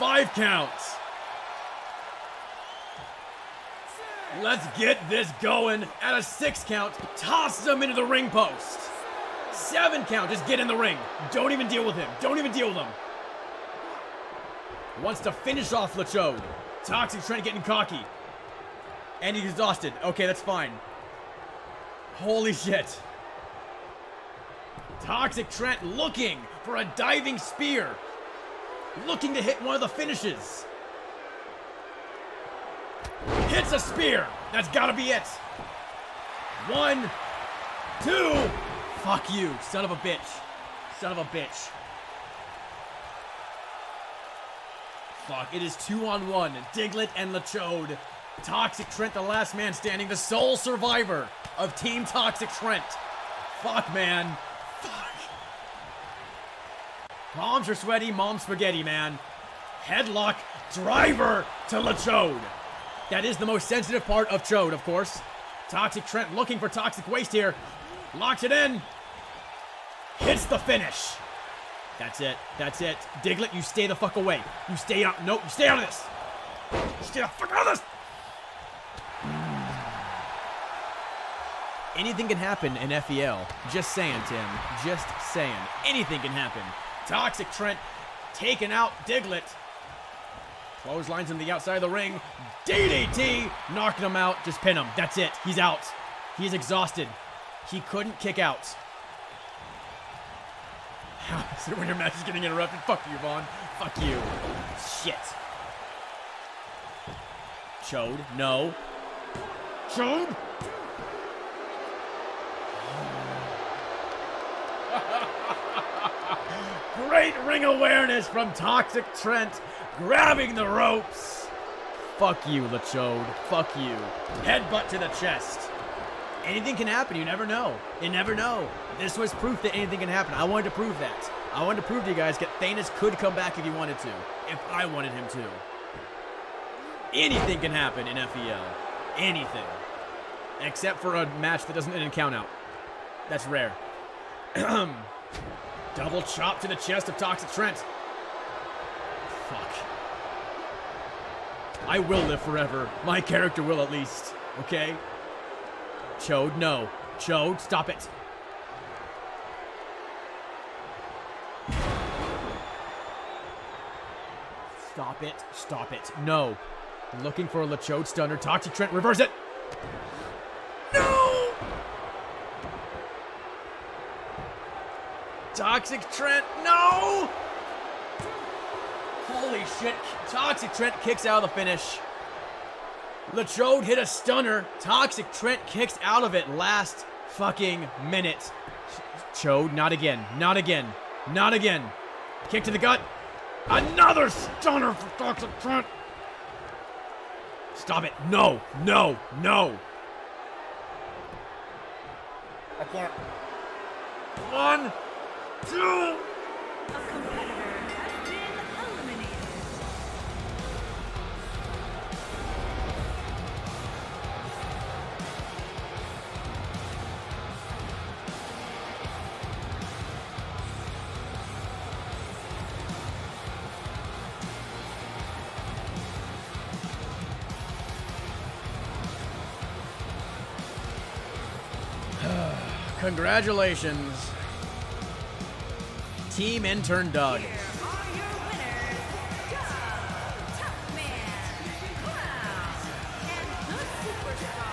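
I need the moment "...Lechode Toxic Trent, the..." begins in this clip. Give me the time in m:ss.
0:47.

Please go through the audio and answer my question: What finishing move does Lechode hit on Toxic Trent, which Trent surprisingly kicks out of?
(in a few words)
Chode stunner.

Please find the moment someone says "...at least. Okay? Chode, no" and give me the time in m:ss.
2:33.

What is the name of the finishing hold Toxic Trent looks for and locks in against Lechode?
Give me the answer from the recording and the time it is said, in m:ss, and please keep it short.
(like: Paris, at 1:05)
Toxic Waste, at 1:06.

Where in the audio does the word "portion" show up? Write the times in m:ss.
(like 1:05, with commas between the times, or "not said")
not said.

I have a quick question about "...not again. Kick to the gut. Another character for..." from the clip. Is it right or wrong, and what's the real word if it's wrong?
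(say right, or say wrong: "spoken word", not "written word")
wrong: "stunner", not "character".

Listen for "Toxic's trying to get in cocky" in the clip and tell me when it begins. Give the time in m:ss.
0:16.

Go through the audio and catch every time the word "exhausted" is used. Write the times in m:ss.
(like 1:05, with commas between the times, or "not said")
0:19, 1:36.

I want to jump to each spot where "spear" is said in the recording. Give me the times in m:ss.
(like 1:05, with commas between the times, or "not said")
0:27, 0:33.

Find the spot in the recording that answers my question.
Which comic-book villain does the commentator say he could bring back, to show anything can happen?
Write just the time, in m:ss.
2:12.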